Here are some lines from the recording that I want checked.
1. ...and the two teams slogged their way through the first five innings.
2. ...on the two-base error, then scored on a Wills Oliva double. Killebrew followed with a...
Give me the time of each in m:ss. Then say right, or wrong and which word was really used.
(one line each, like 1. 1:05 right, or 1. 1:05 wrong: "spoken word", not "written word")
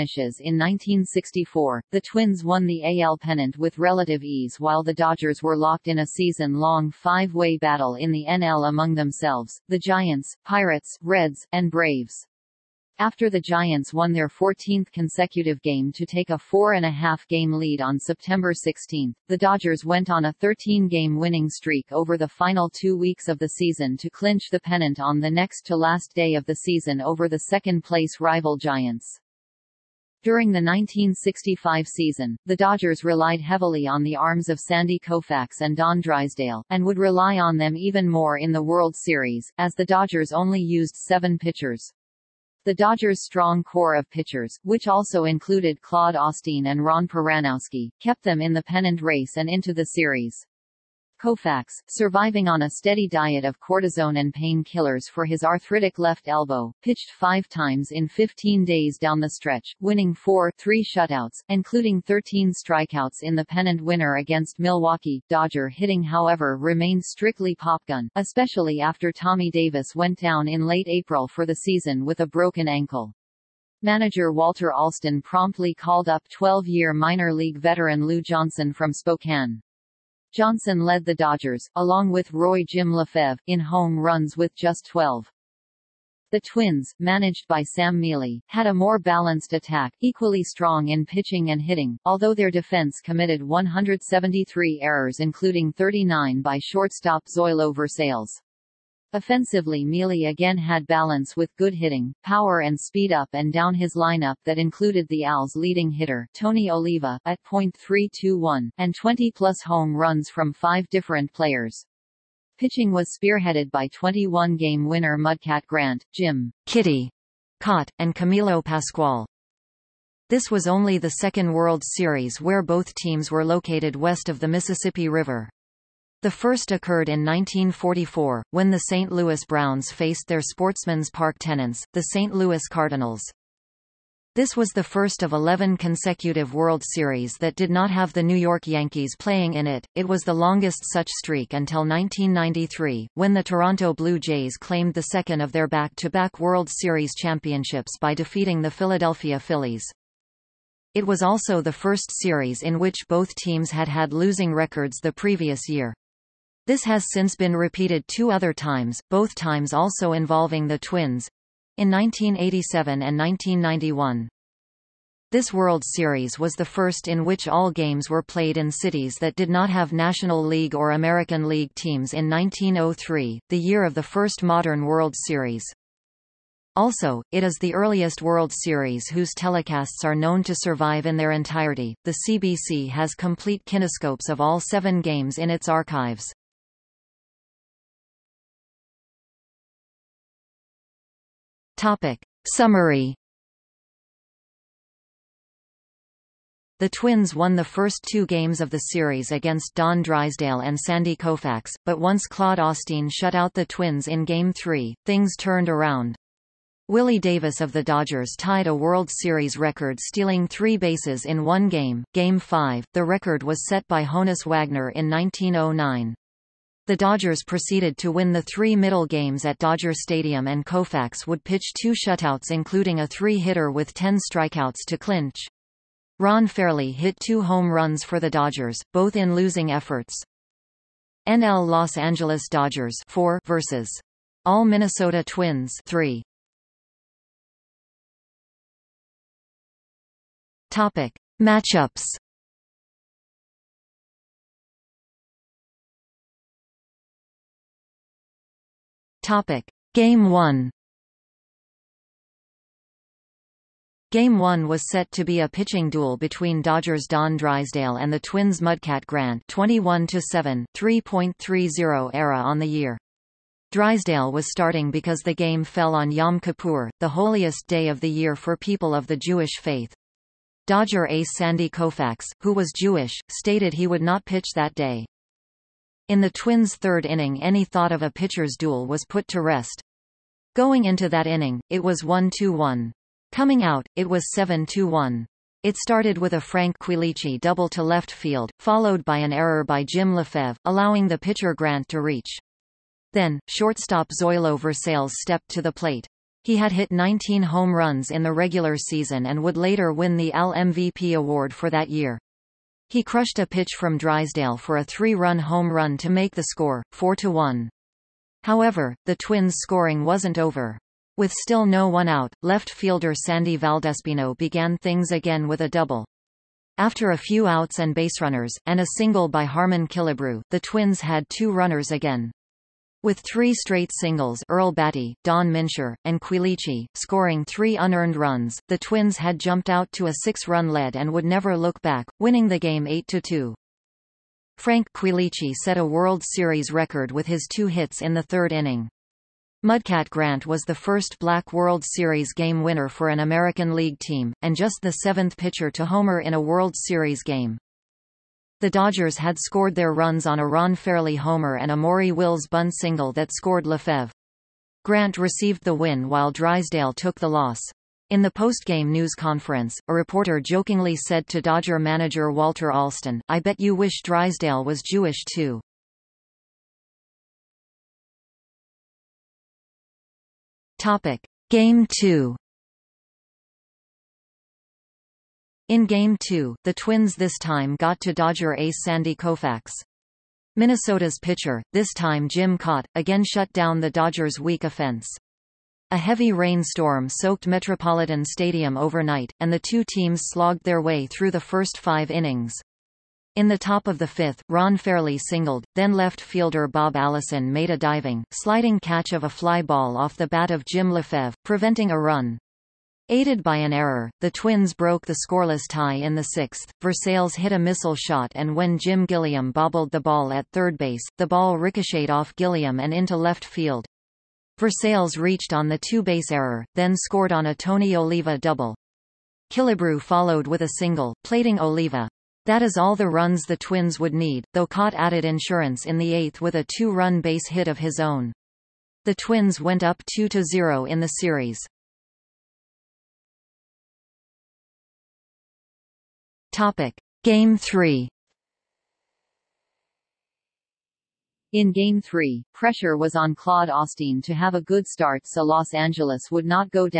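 1. 6:29 right
2. 6:55 wrong: "Tony", not "Wills".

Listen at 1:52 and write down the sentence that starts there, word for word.
Pitching was spearheaded by 21-game winner Mudcat Grant, Jim Kitty Kaat, and Camilo Pascual.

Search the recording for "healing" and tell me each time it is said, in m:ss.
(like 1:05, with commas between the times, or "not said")
not said.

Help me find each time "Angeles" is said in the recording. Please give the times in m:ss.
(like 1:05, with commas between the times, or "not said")
3:51, 7:25.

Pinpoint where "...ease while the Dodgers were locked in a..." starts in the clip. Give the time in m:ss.
0:04.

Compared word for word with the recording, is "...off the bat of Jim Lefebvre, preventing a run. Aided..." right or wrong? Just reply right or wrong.
right.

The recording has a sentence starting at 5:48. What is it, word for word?
The Dodgers had scored their runs on a Ron Fairly homer and a Maury Wills bunt single that scored Lefebvre.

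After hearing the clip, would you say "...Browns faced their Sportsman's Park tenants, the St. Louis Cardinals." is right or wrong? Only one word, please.
right.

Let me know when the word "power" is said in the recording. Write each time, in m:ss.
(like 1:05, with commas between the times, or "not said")
1:42.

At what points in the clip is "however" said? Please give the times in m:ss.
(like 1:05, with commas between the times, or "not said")
1:06, 5:08.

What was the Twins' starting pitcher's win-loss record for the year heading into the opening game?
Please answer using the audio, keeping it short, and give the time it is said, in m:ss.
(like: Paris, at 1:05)
21-7, at 4:19.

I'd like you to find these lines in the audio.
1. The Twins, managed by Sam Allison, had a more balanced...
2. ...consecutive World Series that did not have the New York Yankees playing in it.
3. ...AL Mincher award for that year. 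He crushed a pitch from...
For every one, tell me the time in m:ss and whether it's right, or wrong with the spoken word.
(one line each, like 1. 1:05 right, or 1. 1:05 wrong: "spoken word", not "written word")
1. 1:26 wrong: "Mele", not "Allison"
2. 2:15 right
3. 5:00 wrong: "MVP", not "Mincher".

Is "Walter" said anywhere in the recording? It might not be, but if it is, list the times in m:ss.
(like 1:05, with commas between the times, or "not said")
1:14, 6:02.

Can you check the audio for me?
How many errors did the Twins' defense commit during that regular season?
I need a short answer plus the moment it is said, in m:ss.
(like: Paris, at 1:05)
173, at 1:33.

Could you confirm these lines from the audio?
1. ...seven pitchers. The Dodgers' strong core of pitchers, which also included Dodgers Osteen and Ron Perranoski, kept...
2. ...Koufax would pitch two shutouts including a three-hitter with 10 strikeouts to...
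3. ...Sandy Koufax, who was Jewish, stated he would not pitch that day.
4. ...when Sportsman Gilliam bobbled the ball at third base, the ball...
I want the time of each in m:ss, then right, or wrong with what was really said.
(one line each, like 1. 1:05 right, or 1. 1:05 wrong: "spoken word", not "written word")
1. 0:40 wrong: "Claude", not "Dodgers"
2. 3:40 right
3. 4:31 right
4. 6:48 wrong: "Jim", not "Sportsman".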